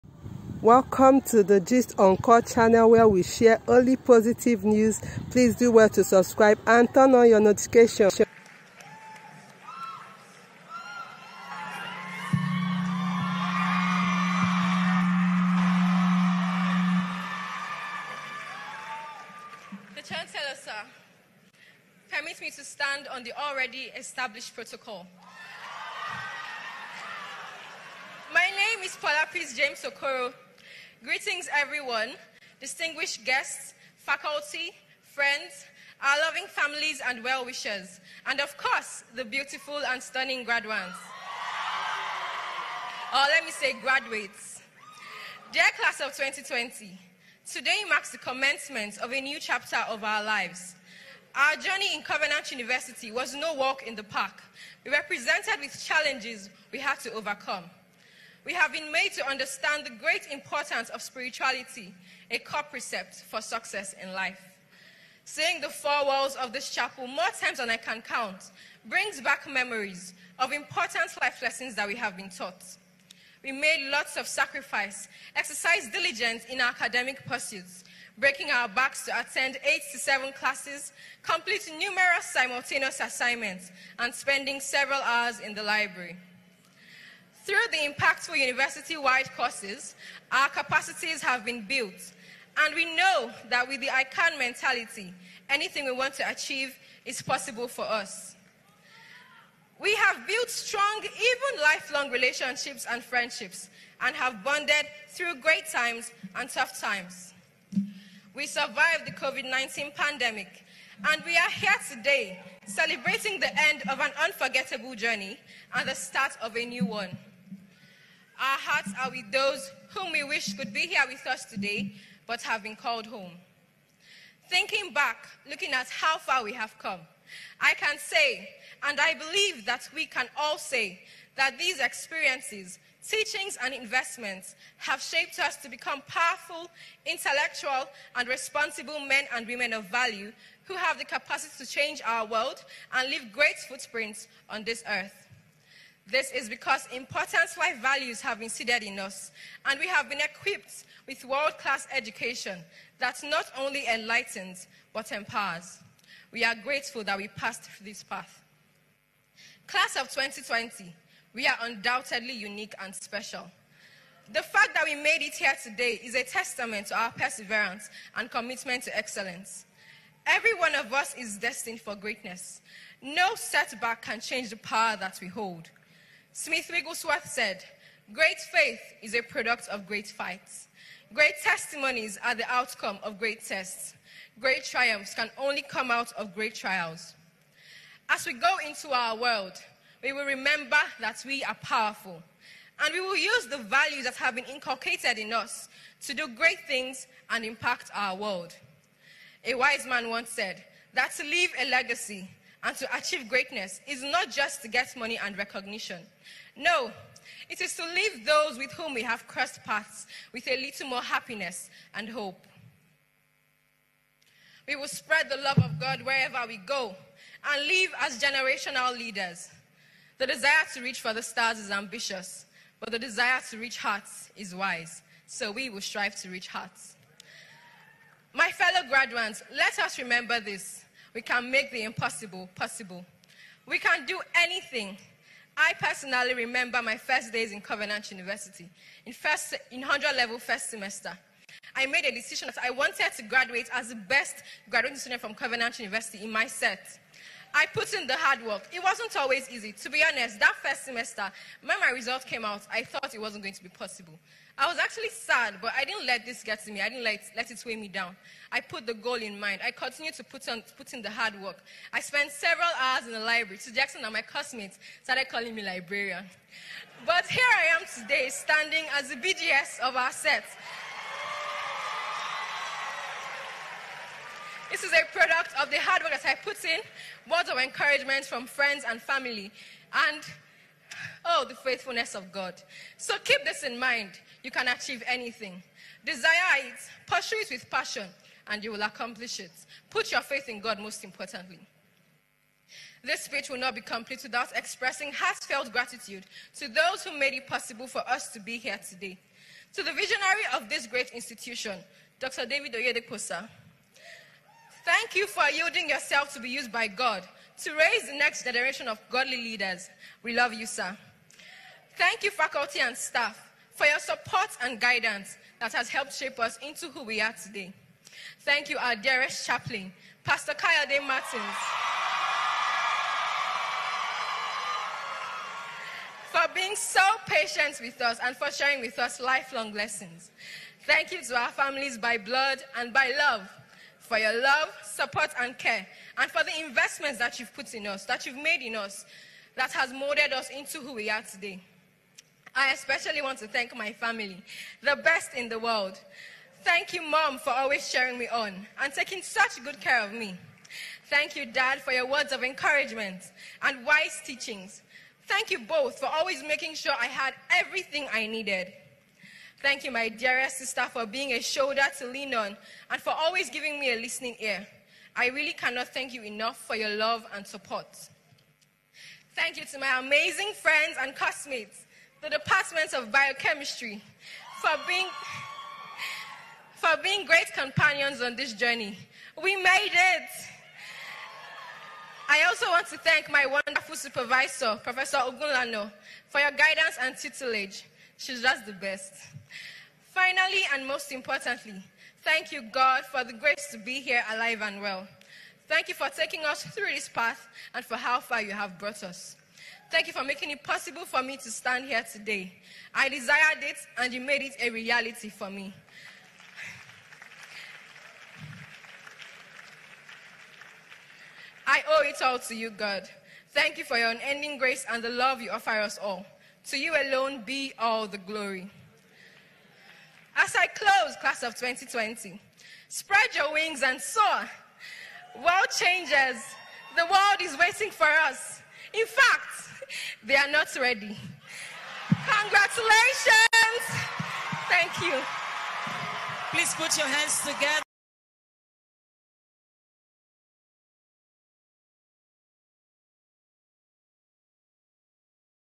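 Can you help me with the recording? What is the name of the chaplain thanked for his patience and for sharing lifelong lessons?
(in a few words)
Pastor Kayode Martins.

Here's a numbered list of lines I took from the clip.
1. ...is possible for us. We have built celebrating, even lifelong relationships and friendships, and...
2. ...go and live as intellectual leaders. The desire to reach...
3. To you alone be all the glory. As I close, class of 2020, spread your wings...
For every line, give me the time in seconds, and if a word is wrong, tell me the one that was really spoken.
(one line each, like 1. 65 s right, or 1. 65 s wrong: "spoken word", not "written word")
1. 97 s wrong: "strong", not "celebrating"
2. 216 s wrong: "generational", not "intellectual"
3. 416 s right.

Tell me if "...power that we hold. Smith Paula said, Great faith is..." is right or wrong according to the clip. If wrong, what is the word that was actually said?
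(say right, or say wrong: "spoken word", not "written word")
wrong: "Wigglesworth", not "Paula".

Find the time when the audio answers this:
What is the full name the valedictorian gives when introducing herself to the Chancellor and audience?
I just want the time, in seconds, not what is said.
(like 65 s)
28 s.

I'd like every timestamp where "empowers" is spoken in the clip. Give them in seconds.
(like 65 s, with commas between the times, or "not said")
155 s.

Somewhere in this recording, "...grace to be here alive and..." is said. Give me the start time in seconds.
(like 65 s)
393 s.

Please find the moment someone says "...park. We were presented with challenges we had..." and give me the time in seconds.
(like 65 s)
54 s.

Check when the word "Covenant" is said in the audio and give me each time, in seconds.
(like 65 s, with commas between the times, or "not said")
52 s, 237 s, 245 s.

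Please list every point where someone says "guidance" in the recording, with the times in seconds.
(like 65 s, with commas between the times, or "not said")
314 s, 386 s.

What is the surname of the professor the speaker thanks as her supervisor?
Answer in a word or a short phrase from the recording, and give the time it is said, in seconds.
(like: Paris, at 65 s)
Ogunlana, at 385 s.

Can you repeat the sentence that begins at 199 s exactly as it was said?
A wise man once said that to leave a legacy and to achieve greatness is not just to get money and recognition.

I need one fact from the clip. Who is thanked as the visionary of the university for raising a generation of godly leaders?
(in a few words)
Dr. David Oyedepo.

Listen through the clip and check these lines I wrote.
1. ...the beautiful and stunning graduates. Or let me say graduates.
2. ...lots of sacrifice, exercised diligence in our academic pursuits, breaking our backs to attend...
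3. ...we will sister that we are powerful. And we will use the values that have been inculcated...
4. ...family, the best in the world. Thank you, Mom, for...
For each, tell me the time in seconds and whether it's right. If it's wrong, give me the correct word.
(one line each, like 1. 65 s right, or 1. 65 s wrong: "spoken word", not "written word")
1. 39 s right
2. 73 s right
3. 190 s wrong: "remember", not "sister"
4. 343 s right.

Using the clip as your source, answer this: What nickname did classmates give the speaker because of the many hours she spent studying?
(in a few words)
librarian.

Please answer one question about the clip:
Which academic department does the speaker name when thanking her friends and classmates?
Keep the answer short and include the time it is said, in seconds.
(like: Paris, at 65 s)
biochemistry, at 373 s.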